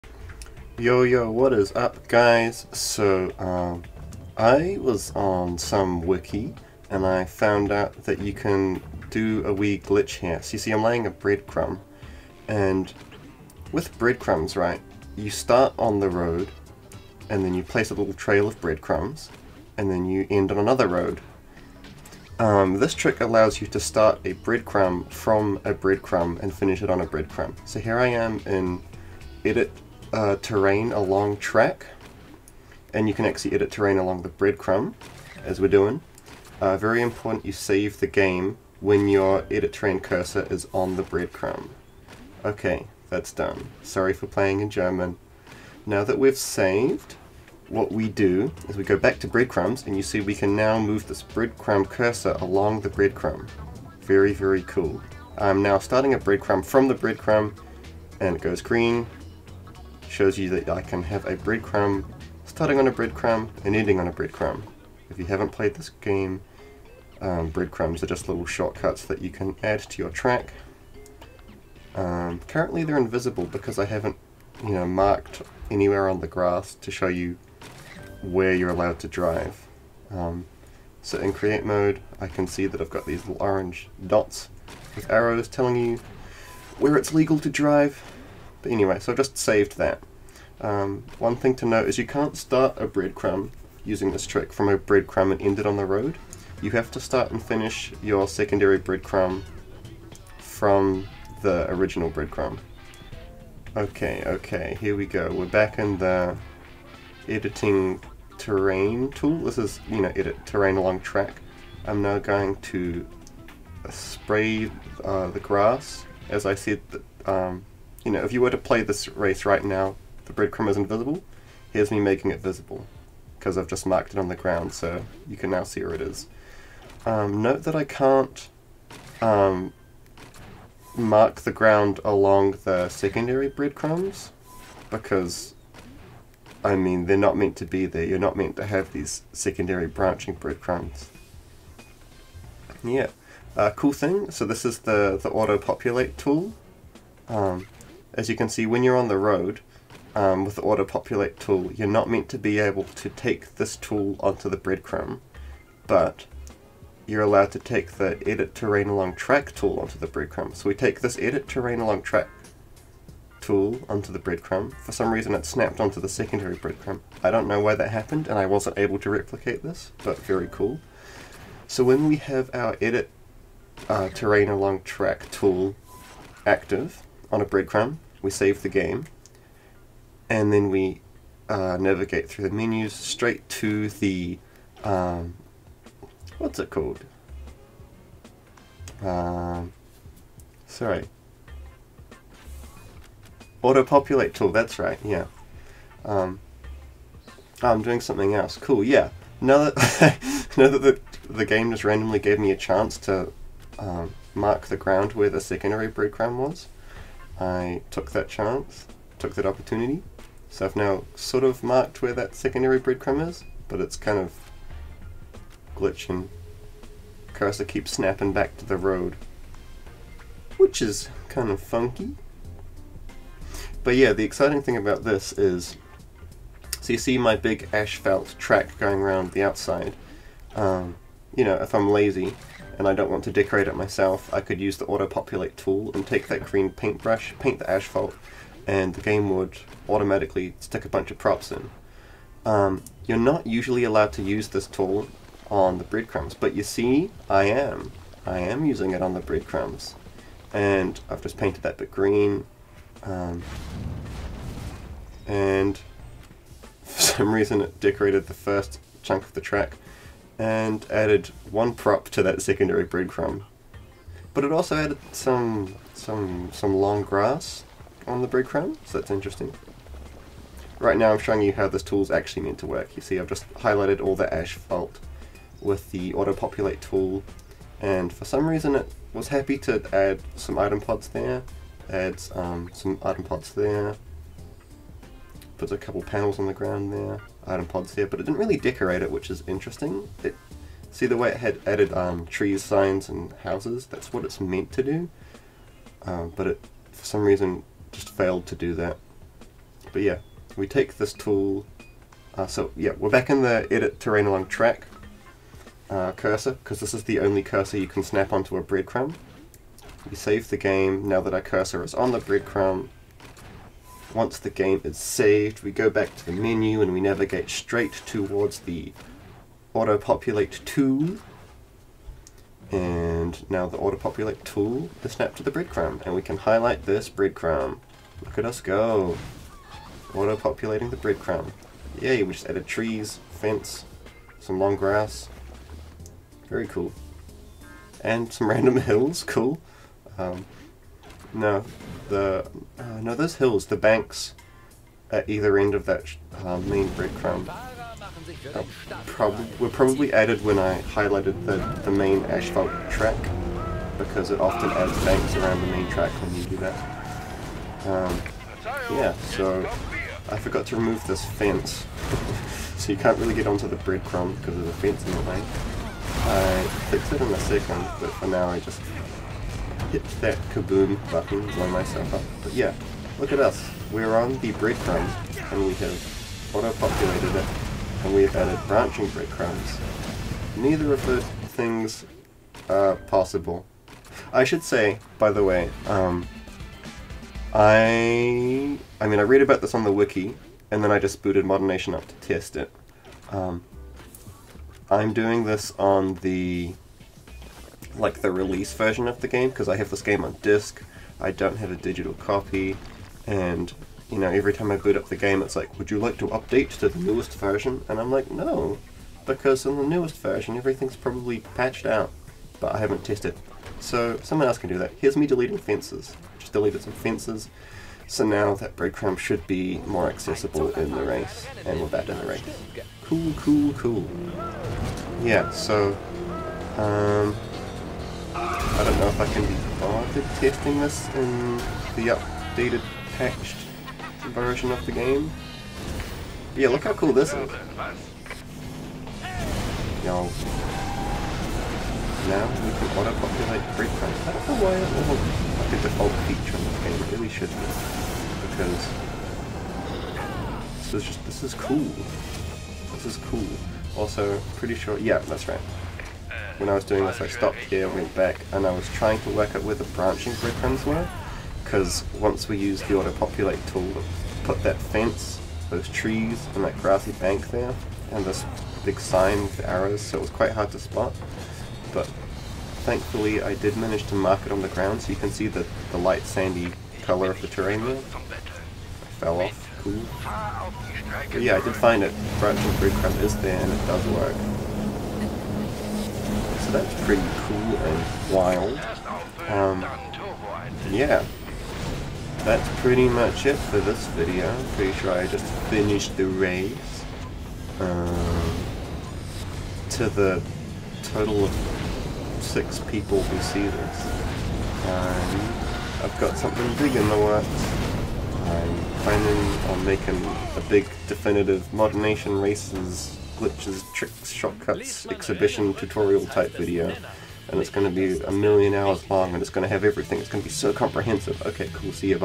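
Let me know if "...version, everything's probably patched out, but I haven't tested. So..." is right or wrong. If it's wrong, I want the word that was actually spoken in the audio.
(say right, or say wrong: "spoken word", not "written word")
right.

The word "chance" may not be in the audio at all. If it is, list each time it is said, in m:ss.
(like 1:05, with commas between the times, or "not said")
3:22, 3:28.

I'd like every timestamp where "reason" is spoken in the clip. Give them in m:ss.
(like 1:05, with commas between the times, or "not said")
2:45, 4:17, 4:38, 4:57.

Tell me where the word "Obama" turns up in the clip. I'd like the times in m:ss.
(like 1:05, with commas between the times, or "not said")
not said.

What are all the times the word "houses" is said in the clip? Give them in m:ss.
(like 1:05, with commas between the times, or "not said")
4:53.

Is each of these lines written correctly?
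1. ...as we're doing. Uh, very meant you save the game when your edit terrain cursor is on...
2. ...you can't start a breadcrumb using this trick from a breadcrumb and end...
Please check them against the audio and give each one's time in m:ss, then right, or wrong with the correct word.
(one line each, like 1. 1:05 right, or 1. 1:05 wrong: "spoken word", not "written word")
1. 0:35 wrong: "important", not "meant"
2. 1:31 right.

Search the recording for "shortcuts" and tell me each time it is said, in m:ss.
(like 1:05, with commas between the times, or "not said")
1:08, 8:34.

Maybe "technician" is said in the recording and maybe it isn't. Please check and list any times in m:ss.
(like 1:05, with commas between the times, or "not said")
not said.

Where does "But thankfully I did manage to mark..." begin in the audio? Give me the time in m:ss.
7:51.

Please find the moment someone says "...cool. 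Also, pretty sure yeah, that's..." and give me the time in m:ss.
7:33.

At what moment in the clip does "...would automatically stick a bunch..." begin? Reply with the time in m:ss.
3:59.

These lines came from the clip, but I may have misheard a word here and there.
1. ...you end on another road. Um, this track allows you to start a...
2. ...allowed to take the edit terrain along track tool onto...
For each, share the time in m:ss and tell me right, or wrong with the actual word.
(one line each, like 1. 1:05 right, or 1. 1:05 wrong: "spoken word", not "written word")
1. 0:20 wrong: "trick", not "track"
2. 2:37 right.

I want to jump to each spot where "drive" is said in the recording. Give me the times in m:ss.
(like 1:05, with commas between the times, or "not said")
1:19, 1:27.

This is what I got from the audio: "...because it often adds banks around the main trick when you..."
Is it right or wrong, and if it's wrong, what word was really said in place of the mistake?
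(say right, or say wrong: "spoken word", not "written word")
wrong: "track", not "trick".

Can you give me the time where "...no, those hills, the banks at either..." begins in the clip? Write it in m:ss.
5:43.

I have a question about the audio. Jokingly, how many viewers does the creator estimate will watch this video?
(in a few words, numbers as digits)
6.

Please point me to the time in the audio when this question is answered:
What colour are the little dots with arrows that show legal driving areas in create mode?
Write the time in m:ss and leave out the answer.
1:23.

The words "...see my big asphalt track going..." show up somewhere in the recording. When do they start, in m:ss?
3:46.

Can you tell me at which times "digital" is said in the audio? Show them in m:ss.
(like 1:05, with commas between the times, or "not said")
6:41.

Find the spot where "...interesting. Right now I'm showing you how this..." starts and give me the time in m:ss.
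4:29.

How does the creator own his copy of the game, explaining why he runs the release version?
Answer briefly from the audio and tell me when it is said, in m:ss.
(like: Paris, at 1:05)
on disc, at 6:40.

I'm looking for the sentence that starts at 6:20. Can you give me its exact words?
Neither of the things are possible.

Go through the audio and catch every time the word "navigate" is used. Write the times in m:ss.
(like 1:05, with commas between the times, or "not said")
3:01, 5:16.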